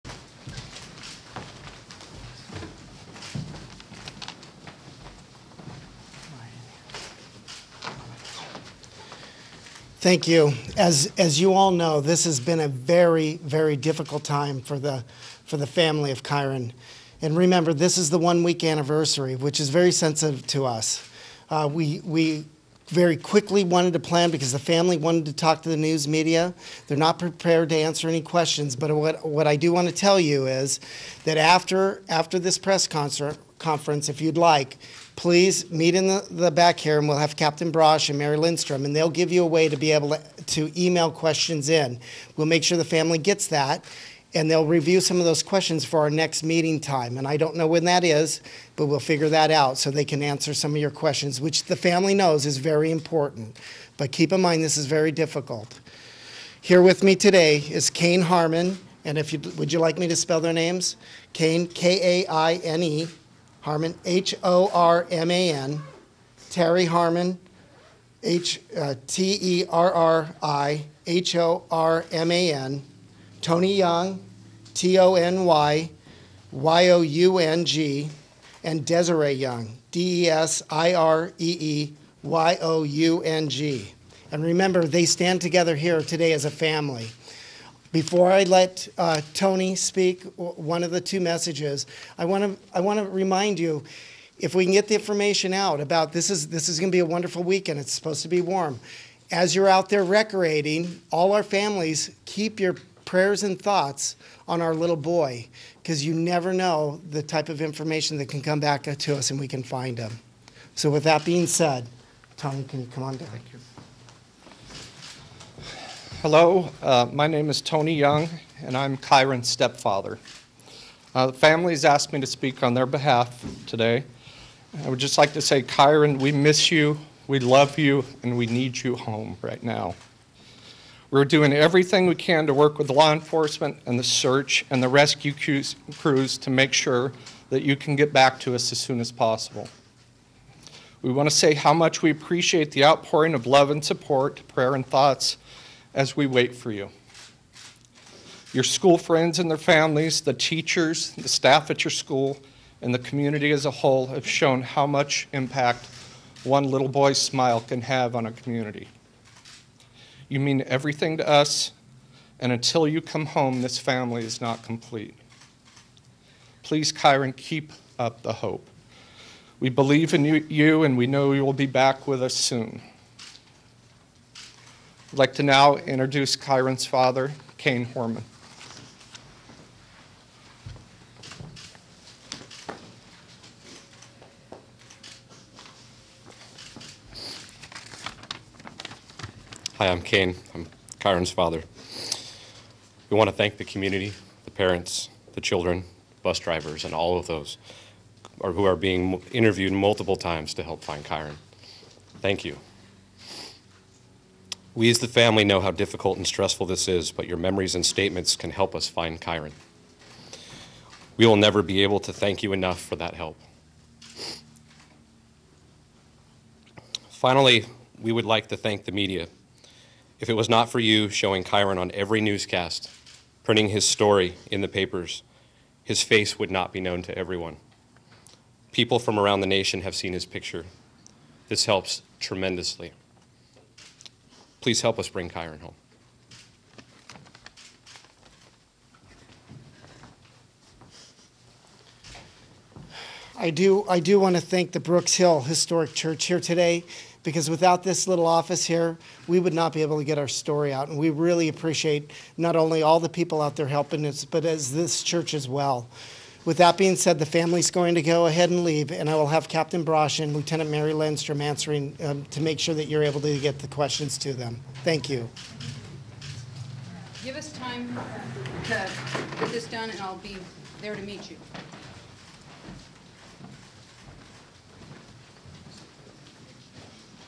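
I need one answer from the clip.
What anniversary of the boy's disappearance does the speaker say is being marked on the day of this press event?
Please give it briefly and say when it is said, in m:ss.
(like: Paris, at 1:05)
One week, at 0:18.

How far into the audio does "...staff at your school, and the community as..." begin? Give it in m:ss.
2:31.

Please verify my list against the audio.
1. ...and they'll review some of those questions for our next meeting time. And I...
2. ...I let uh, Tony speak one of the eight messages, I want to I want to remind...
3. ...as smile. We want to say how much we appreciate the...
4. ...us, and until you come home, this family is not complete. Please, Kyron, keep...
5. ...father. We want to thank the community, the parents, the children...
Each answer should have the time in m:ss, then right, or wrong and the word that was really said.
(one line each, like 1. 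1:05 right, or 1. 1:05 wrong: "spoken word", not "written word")
1. 0:44 right
2. 1:28 wrong: "two", not "eight"
3. 2:18 wrong: "possible", not "smile"
4. 2:41 right
5. 3:11 right.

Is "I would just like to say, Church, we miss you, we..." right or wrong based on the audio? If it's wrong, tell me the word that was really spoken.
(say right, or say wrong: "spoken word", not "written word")
wrong: "Kyron", not "Church".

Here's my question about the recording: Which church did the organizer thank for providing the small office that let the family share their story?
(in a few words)
Brooks Hill Historic Church.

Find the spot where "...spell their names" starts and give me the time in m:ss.
1:00.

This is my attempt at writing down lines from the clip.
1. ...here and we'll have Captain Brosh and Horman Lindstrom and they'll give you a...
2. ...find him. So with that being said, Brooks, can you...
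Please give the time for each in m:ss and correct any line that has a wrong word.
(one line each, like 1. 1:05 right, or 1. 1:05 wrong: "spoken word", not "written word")
1. 0:36 wrong: "Mary", not "Horman"
2. 1:49 wrong: "Tony", not "Brooks".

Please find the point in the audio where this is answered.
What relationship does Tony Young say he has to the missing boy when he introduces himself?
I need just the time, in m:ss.
1:59.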